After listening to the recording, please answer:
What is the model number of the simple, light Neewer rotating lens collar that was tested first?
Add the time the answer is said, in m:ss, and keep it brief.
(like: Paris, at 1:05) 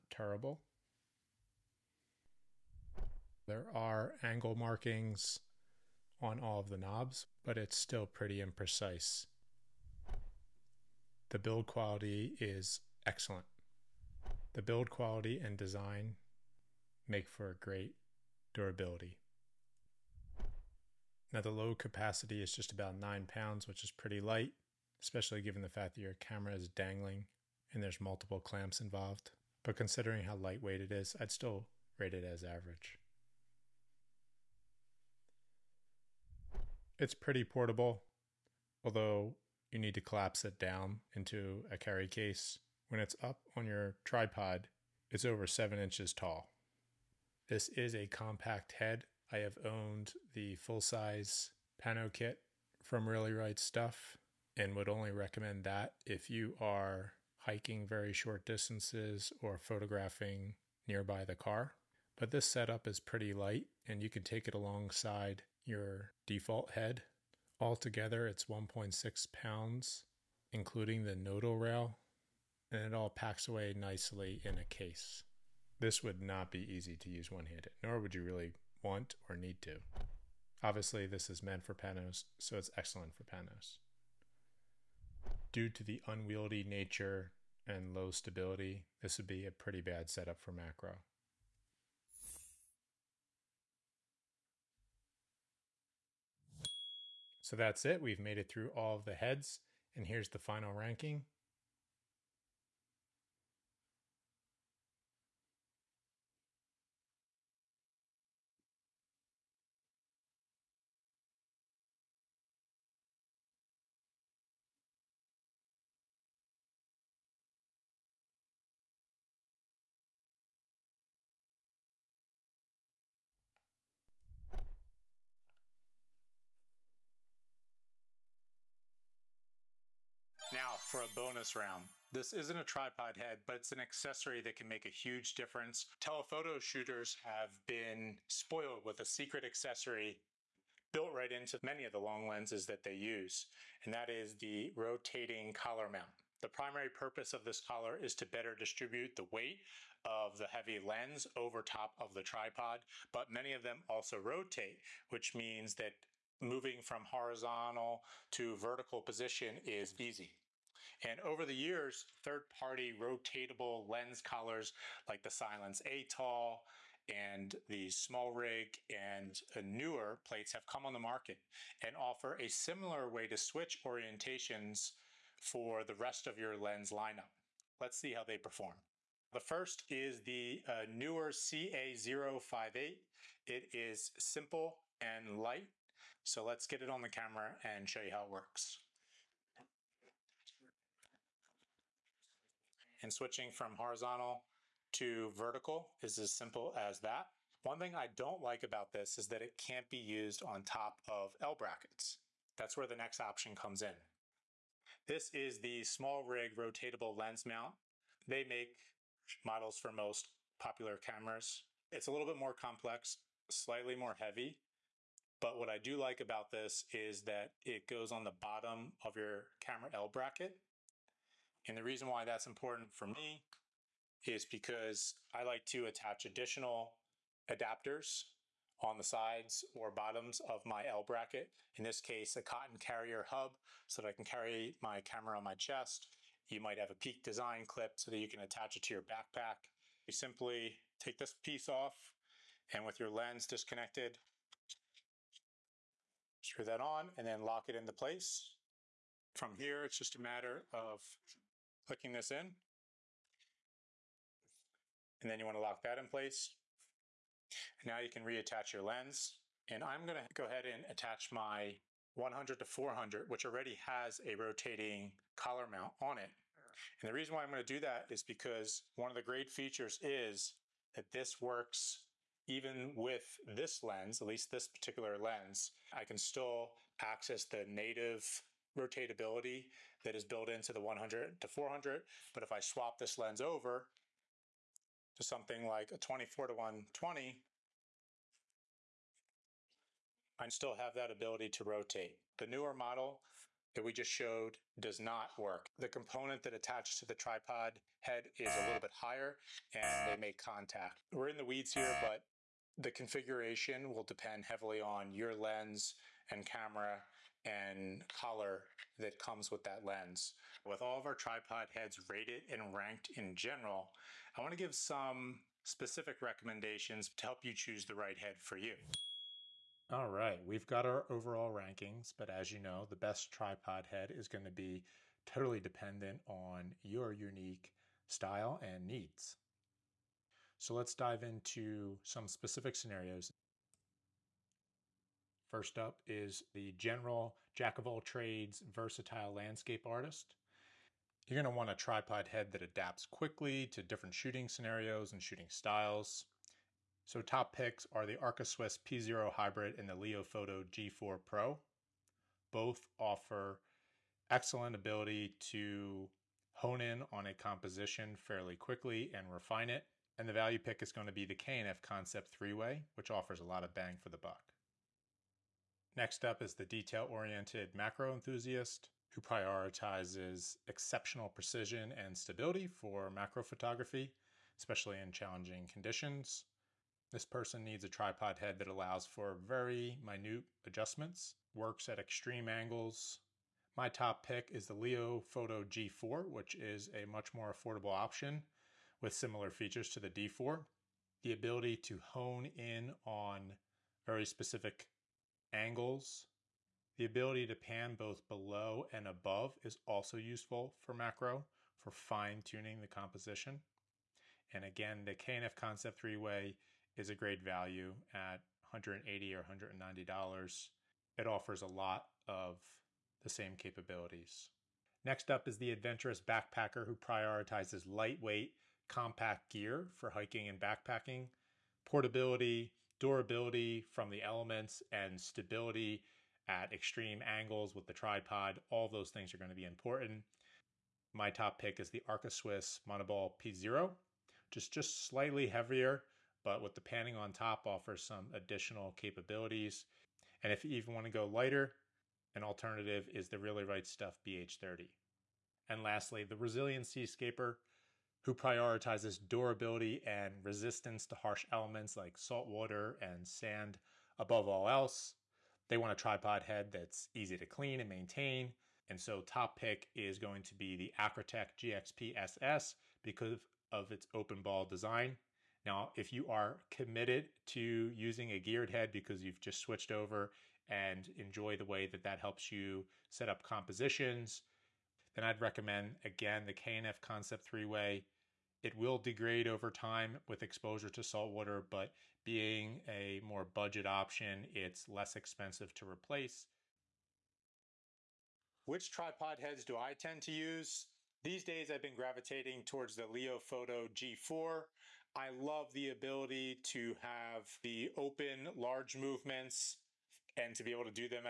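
CA058, at 3:01.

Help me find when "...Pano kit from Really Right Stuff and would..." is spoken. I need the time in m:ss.
0:51.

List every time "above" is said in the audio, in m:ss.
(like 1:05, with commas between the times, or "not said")
6:39, 7:34.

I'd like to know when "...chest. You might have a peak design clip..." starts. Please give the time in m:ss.
3:55.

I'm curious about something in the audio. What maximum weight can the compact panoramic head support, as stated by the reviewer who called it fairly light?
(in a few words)
9 pounds.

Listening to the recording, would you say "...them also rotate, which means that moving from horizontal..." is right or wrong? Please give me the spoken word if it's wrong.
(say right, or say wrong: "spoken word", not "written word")
right.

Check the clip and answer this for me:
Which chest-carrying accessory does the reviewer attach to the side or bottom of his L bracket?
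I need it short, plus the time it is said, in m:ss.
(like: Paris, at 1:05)
Cotton Carrier hub, at 3:52.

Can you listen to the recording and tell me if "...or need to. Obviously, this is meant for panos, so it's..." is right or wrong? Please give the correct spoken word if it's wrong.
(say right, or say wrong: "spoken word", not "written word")
right.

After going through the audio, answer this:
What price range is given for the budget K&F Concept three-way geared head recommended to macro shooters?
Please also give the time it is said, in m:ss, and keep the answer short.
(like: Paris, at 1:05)
$180-$190, at 6:48.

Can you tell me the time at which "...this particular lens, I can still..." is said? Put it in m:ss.
4:34.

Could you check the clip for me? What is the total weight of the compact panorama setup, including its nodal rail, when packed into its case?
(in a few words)
1.6 pounds.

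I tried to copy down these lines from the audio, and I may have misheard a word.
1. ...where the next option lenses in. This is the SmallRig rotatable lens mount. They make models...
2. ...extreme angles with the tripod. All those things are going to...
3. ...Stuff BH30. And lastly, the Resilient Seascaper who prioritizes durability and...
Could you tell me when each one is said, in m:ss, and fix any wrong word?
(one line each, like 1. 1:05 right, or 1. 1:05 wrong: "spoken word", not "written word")
1. 3:22 wrong: "comes", not "lenses"
2. 7:06 right
3. 7:23 right.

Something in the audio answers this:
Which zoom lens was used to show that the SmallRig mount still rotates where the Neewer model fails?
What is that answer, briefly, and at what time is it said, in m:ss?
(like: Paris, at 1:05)
24-120, at 4:45.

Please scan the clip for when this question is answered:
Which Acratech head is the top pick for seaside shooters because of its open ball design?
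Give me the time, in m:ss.
7:41.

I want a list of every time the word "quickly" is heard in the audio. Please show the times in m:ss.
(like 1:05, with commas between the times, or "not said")
5:43, 5:58.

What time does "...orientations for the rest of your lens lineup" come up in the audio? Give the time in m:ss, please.
2:53.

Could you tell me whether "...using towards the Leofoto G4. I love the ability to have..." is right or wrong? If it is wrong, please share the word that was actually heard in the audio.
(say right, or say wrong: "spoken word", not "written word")
wrong: "gravitating", not "using".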